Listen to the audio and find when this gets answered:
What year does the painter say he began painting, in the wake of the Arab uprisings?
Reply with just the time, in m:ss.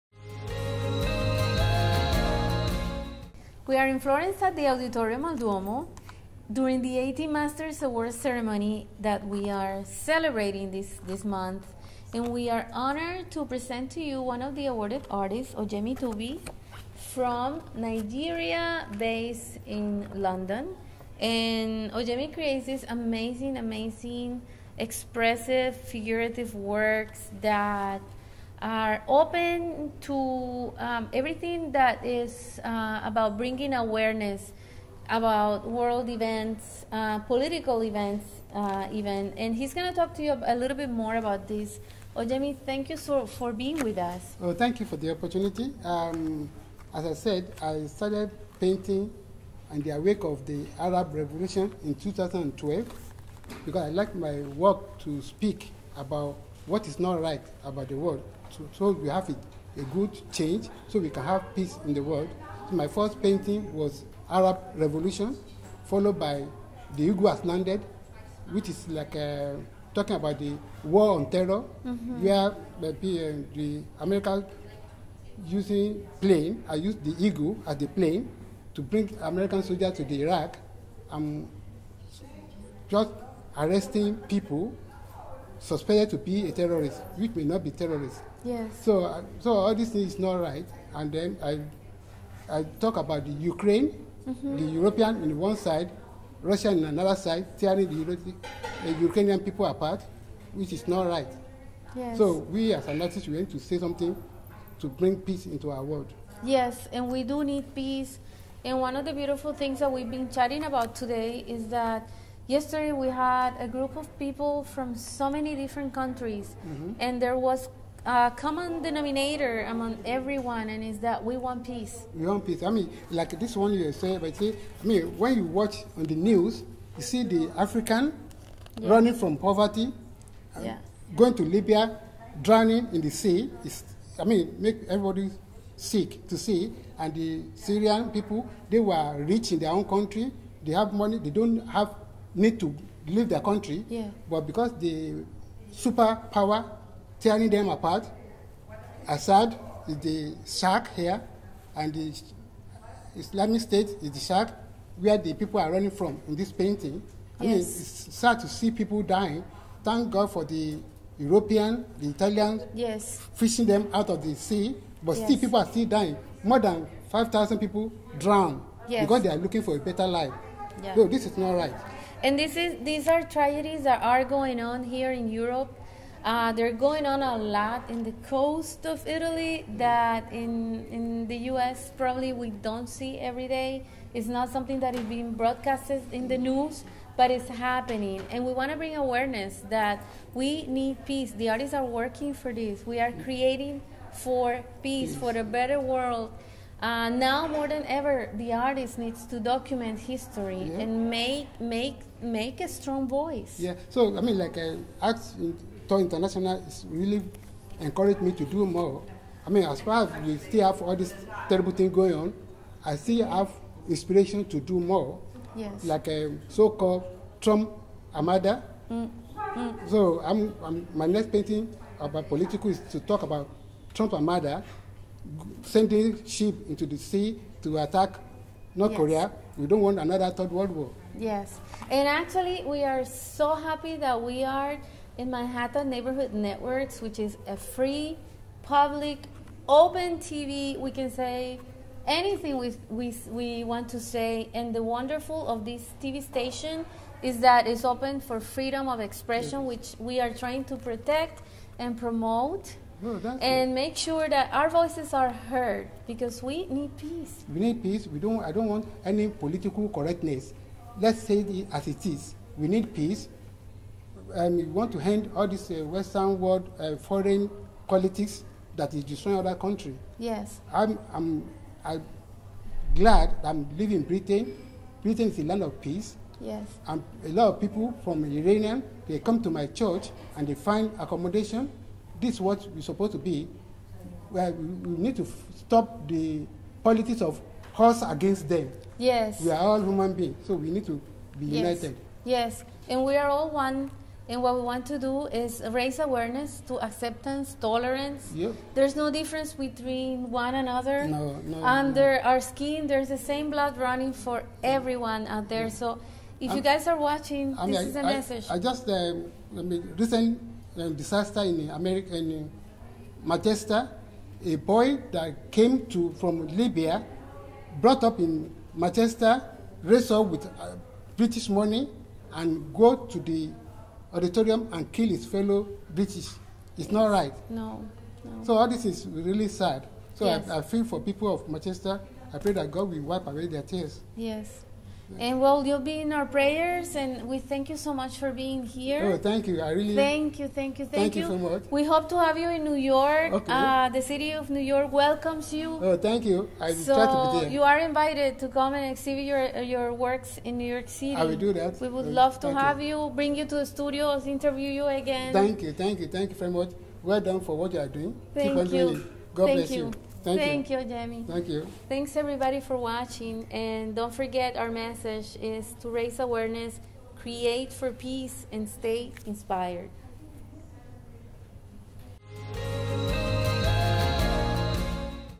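0:51.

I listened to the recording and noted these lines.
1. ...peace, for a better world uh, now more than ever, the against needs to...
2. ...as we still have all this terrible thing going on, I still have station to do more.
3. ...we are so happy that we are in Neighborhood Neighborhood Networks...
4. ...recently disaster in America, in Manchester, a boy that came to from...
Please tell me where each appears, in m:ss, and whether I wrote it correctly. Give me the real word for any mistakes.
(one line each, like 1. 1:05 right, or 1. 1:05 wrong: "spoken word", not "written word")
1. 3:14 wrong: "artist", not "against"
2. 3:30 wrong: "inspiration", not "station"
3. 3:52 wrong: "Manhattan", not "Neighborhood"
4. 5:09 right.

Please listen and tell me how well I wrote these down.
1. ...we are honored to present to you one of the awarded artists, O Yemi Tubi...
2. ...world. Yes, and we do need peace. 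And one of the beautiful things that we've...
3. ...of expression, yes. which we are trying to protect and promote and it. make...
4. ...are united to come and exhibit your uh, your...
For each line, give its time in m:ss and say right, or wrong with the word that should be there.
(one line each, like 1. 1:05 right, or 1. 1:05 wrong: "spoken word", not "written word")
1. 0:12 right
2. 1:45 right
3. 4:08 right
4. 5:47 wrong: "invited", not "united".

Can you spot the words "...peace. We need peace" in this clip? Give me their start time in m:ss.
4:16.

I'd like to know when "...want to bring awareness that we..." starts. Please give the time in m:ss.
3:08.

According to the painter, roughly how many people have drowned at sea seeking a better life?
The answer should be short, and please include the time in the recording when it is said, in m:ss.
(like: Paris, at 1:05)
More than 5,000, at 2:46.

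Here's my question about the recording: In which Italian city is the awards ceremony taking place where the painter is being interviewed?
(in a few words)
Florence.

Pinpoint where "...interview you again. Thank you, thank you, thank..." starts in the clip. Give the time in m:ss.
5:54.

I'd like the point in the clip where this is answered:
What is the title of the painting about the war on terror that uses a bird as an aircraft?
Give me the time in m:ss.
1:06.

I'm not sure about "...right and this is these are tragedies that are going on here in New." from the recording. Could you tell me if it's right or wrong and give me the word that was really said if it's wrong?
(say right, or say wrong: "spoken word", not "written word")
wrong: "Europe", not "New".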